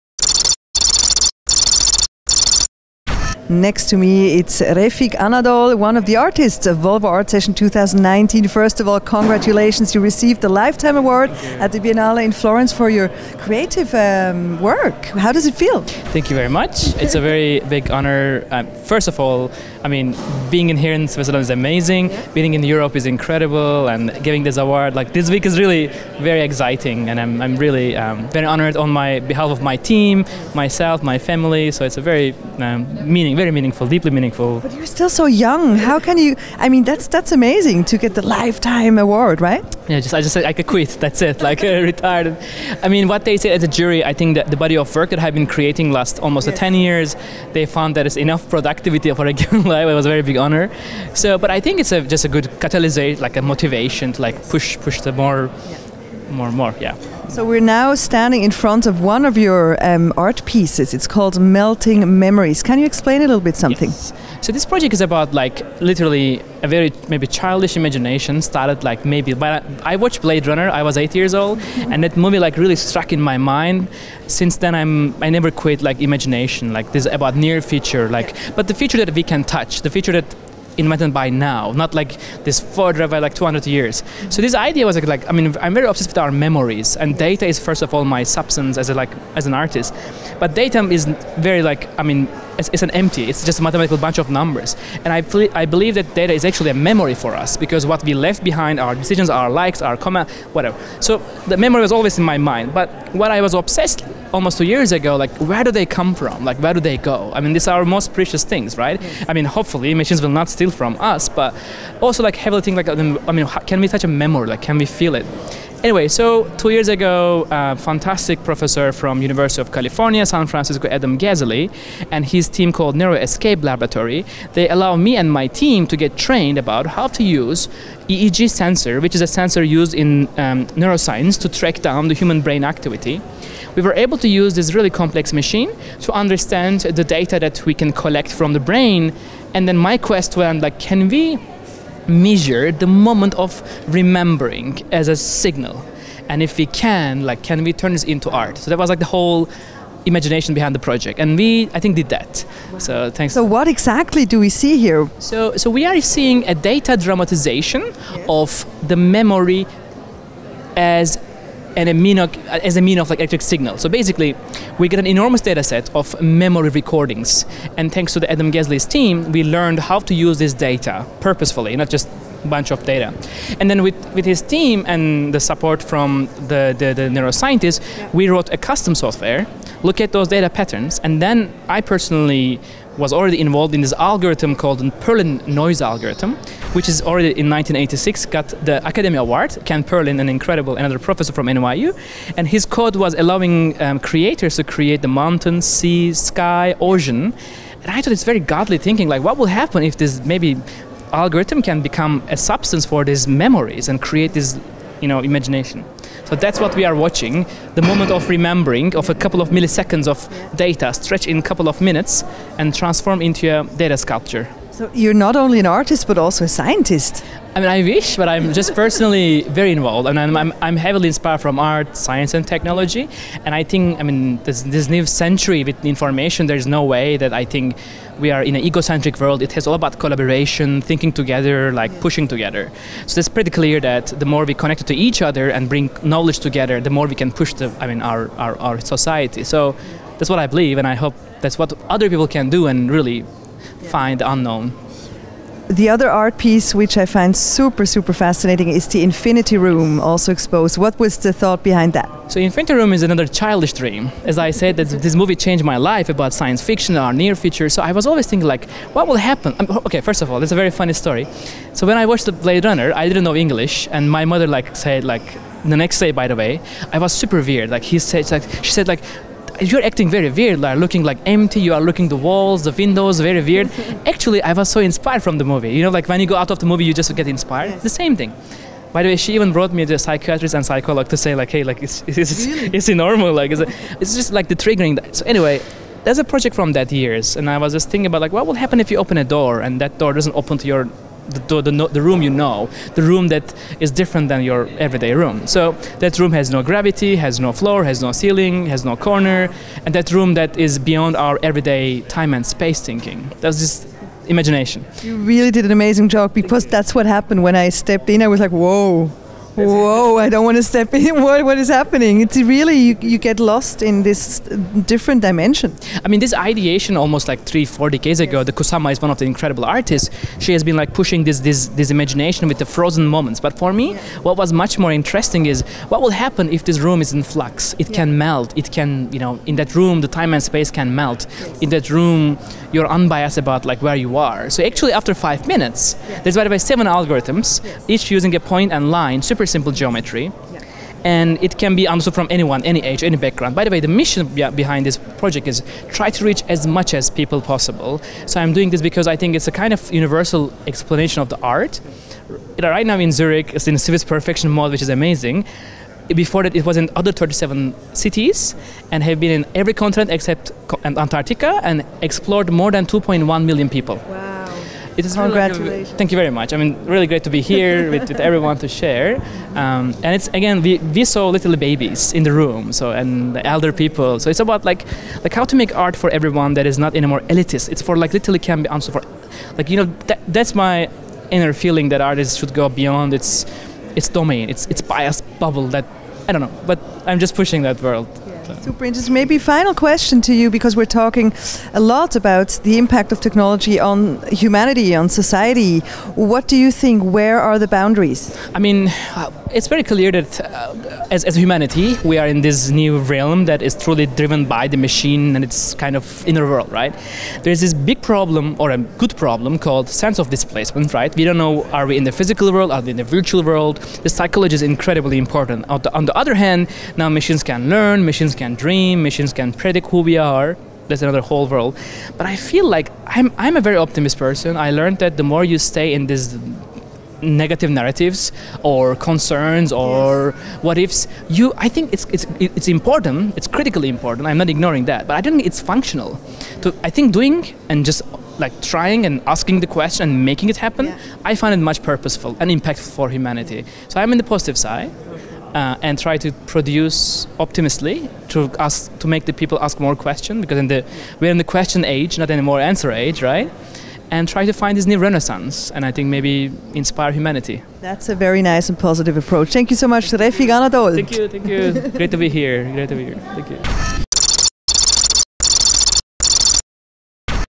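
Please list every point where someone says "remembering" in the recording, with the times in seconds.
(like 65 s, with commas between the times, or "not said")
143 s, 208 s.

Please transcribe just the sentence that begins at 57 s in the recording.
So we're now standing in front of one of your um, art pieces.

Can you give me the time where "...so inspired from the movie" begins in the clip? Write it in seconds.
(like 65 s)
274 s.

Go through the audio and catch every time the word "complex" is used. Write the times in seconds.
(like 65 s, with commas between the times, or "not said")
134 s.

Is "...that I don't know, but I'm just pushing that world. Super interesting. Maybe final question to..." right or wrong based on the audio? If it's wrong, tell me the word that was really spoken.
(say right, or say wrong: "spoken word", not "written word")
right.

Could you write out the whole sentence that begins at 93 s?
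It's just a mathematical bunch of numbers.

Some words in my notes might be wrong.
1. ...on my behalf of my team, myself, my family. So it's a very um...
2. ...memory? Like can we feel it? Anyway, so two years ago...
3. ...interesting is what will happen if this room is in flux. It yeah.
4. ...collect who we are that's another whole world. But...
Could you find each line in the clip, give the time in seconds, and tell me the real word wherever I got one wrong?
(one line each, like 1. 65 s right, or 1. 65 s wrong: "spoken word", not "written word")
1. 28 s right
2. 114 s right
3. 324 s right
4. 419 s wrong: "predict", not "collect".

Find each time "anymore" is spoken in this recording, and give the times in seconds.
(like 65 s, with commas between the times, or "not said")
376 s, 452 s.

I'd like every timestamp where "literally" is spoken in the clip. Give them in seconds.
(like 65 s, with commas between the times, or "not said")
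65 s, 378 s.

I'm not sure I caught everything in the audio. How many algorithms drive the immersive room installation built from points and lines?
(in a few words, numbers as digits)
7.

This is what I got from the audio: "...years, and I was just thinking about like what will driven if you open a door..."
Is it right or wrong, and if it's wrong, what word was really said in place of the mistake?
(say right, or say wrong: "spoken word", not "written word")
wrong: "happen", not "driven".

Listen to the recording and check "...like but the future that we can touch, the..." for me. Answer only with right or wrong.
right.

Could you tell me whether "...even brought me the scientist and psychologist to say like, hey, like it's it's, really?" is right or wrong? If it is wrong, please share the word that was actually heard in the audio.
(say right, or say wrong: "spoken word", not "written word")
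wrong: "psychiatrist", not "scientist".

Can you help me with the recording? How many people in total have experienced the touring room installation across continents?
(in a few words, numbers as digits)
2.1 million.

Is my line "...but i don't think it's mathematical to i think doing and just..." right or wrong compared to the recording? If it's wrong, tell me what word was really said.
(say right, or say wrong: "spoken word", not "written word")
wrong: "functional", not "mathematical".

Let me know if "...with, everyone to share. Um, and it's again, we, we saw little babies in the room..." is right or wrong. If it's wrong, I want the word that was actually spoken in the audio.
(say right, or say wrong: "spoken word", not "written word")
right.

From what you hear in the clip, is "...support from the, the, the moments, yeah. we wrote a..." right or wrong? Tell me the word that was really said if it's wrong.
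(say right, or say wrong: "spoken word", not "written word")
wrong: "neuroscientists", not "moments".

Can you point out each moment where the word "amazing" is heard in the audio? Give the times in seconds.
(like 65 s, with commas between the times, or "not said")
21 s, 37 s, 305 s, 354 s.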